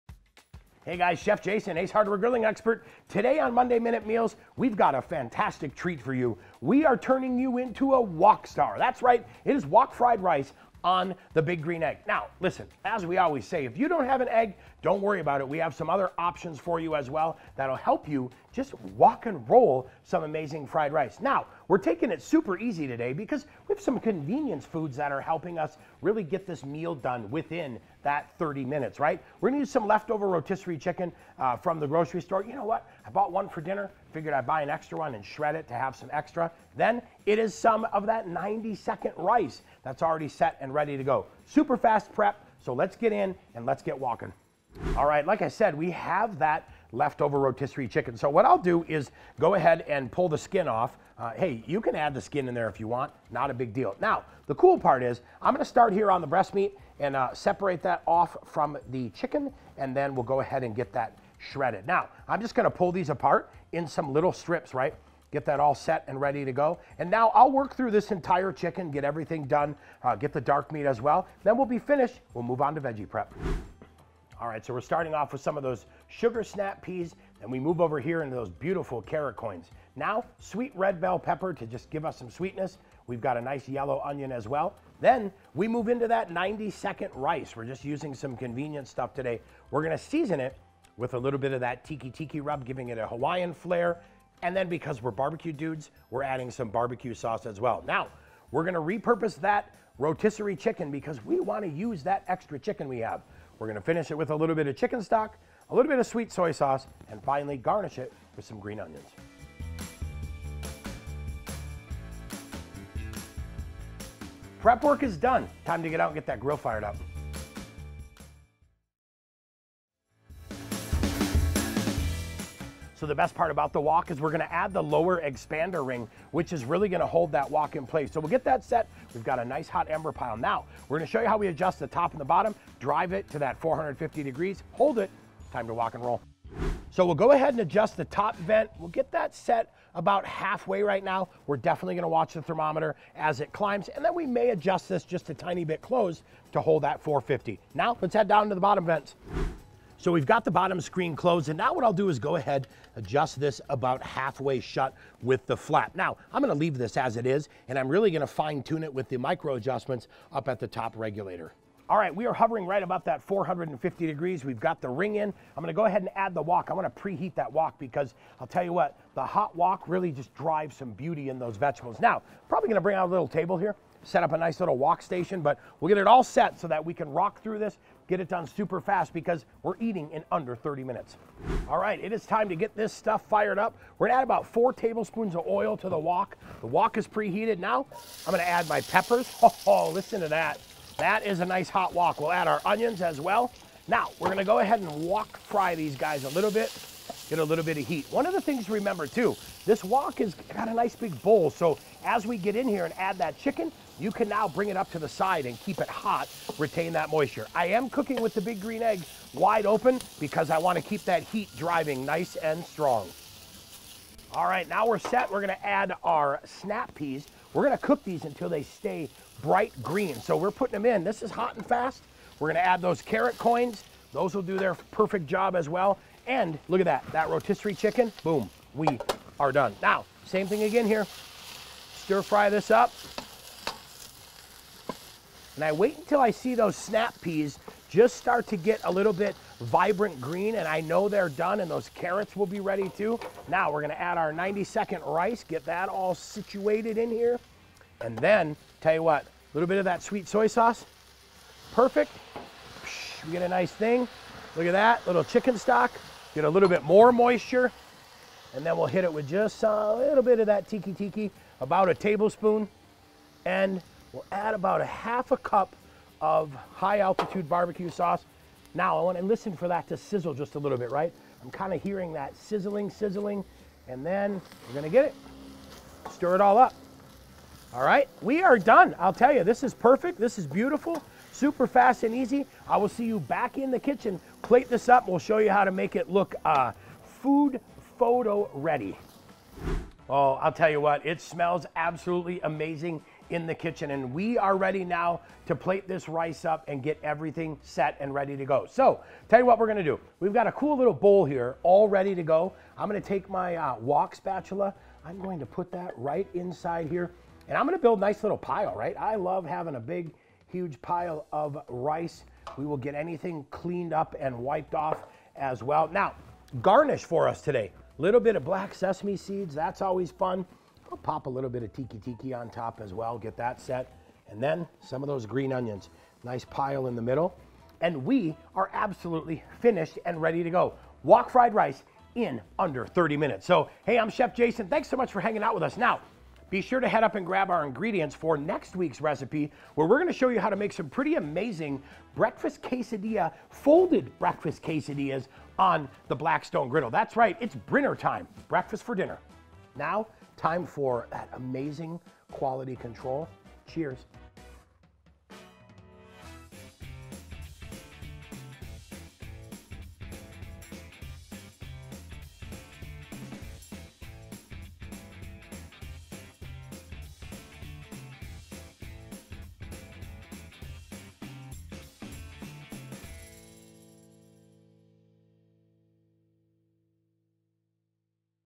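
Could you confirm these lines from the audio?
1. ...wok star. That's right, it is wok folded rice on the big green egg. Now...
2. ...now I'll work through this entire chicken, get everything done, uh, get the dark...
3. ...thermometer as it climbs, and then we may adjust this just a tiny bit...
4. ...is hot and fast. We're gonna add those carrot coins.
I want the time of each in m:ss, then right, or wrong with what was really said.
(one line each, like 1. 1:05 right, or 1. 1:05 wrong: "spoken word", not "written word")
1. 0:08 wrong: "fried", not "folded"
2. 1:07 right
3. 2:22 right
4. 3:41 right.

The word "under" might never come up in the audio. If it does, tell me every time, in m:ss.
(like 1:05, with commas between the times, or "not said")
3:00, 5:32.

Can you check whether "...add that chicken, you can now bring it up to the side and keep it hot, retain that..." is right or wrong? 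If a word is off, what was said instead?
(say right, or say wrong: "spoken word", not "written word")
right.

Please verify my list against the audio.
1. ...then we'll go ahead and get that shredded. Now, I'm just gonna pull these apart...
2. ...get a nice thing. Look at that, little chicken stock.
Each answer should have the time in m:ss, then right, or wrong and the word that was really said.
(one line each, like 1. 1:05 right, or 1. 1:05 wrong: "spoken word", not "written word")
1. 0:59 right
2. 4:13 right.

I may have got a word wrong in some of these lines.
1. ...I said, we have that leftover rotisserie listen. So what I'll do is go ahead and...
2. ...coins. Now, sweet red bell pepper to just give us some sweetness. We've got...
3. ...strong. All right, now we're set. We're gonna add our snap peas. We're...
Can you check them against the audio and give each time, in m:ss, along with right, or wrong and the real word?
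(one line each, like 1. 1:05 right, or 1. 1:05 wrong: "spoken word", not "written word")
1. 0:45 wrong: "chicken", not "listen"
2. 1:19 right
3. 3:32 right.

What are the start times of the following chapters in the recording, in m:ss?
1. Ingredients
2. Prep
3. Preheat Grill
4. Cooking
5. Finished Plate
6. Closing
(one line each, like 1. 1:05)
1. 0:29
2. 0:44
3. 1:57
4. 3:01
5. 4:49
6. 5:33.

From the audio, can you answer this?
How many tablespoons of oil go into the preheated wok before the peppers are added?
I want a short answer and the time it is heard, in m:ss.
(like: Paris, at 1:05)
4, at 3:04.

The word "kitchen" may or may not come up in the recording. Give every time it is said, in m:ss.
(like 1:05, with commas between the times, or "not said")
4:43, 4:53.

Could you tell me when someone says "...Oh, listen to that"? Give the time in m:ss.
3:09.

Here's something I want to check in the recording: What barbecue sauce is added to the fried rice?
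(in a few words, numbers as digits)
high altitude barbecue sauce.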